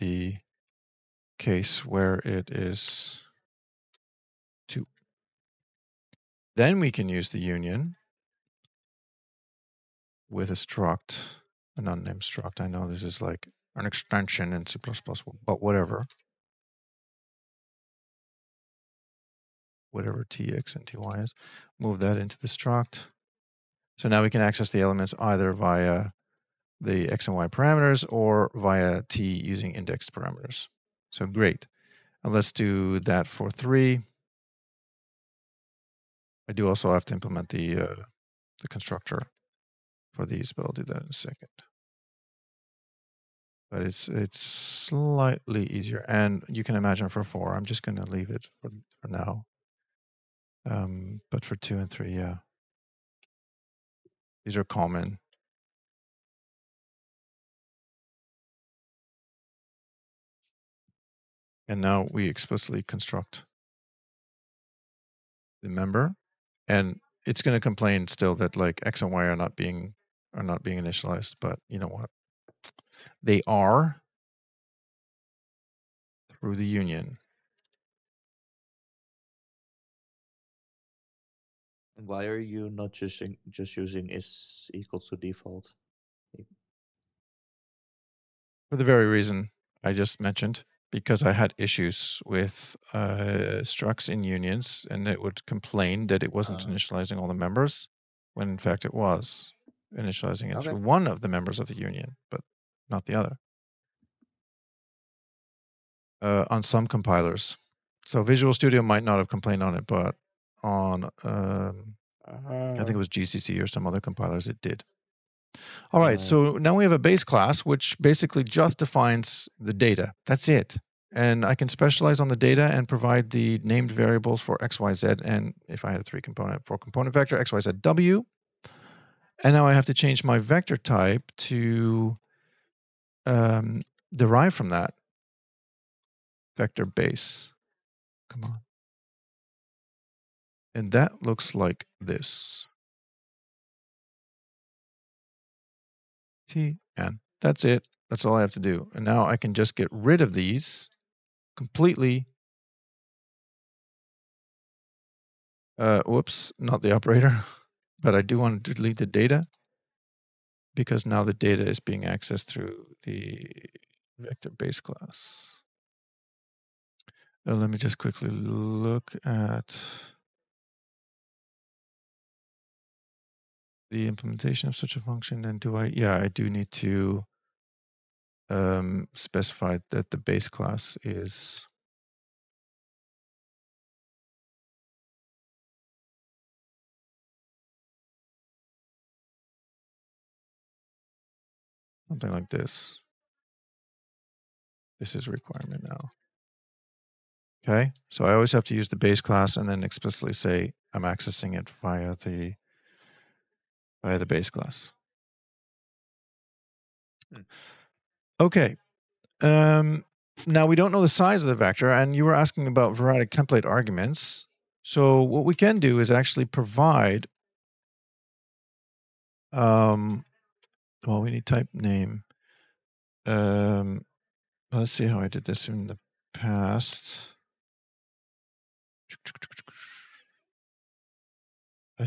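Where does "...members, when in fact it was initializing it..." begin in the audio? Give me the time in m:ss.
1:37.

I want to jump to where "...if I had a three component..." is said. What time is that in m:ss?
2:05.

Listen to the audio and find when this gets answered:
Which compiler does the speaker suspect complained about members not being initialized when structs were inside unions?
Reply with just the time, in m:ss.
1:53.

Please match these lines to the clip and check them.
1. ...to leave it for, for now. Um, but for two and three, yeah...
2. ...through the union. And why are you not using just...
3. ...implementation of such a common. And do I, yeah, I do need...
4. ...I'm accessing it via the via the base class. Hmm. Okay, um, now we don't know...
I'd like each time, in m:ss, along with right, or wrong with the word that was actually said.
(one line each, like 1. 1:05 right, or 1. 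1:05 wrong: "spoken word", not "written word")
1. 0:47 right
2. 1:16 right
3. 2:54 wrong: "function", not "common"
4. 3:20 right.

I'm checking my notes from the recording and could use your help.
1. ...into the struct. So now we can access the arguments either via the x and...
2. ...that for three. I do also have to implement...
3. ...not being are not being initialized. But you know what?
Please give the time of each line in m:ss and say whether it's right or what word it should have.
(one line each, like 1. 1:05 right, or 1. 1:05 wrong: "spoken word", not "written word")
1. 0:22 wrong: "elements", not "arguments"
2. 0:32 right
3. 1:09 right.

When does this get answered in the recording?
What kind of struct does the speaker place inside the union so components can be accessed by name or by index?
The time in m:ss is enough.
0:11.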